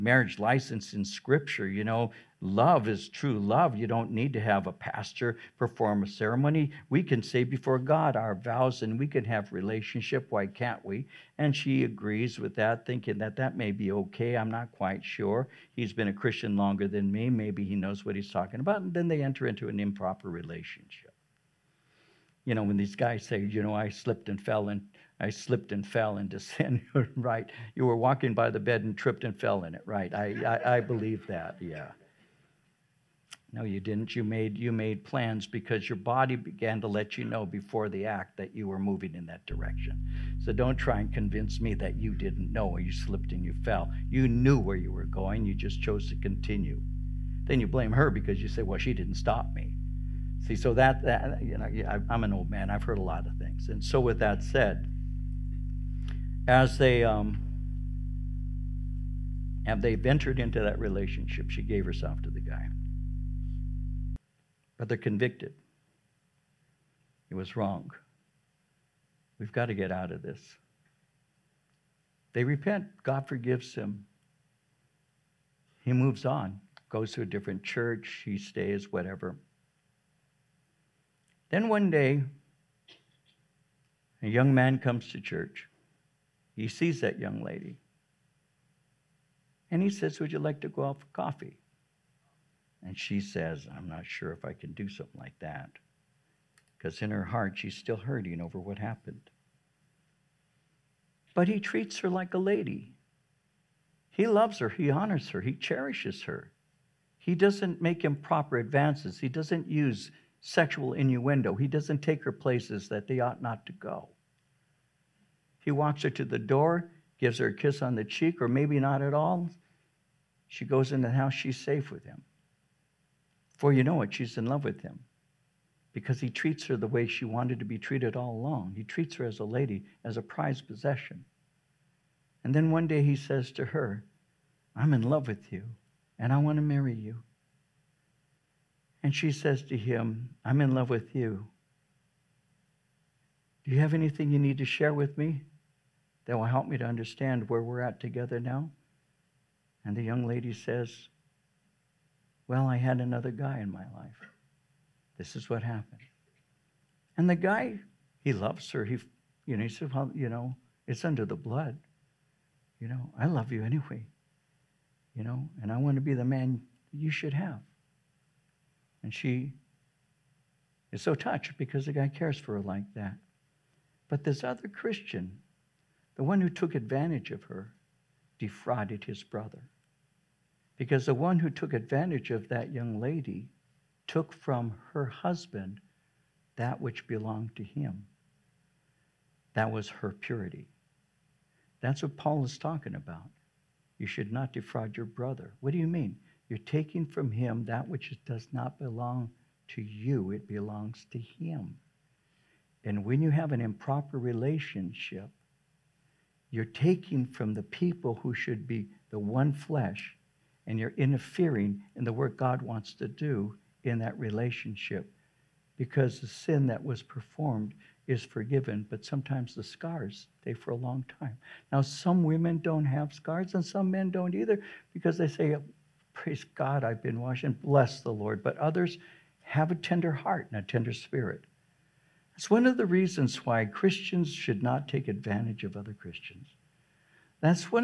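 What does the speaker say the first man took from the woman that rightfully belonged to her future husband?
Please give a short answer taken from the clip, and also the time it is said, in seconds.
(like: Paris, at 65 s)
Her purity, at 189 s.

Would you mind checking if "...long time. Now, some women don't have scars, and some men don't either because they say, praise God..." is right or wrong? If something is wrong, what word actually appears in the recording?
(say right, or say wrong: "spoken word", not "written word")
right.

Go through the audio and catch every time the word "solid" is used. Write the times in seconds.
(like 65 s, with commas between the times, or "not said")
not said.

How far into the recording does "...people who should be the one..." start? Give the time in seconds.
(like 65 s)
207 s.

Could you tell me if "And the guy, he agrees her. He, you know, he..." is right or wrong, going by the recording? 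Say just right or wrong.
wrong.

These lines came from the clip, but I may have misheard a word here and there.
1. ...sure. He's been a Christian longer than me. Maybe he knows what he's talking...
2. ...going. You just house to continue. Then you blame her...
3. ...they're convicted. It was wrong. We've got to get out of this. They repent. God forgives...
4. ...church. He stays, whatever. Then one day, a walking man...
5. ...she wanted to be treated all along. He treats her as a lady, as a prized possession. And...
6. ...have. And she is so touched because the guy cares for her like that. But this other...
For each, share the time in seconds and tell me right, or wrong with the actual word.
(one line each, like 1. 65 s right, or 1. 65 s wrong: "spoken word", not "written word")
1. 15 s right
2. 45 s wrong: "chose", not "house"
3. 64 s right
4. 77 s wrong: "young", not "walking"
5. 127 s right
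6. 167 s right.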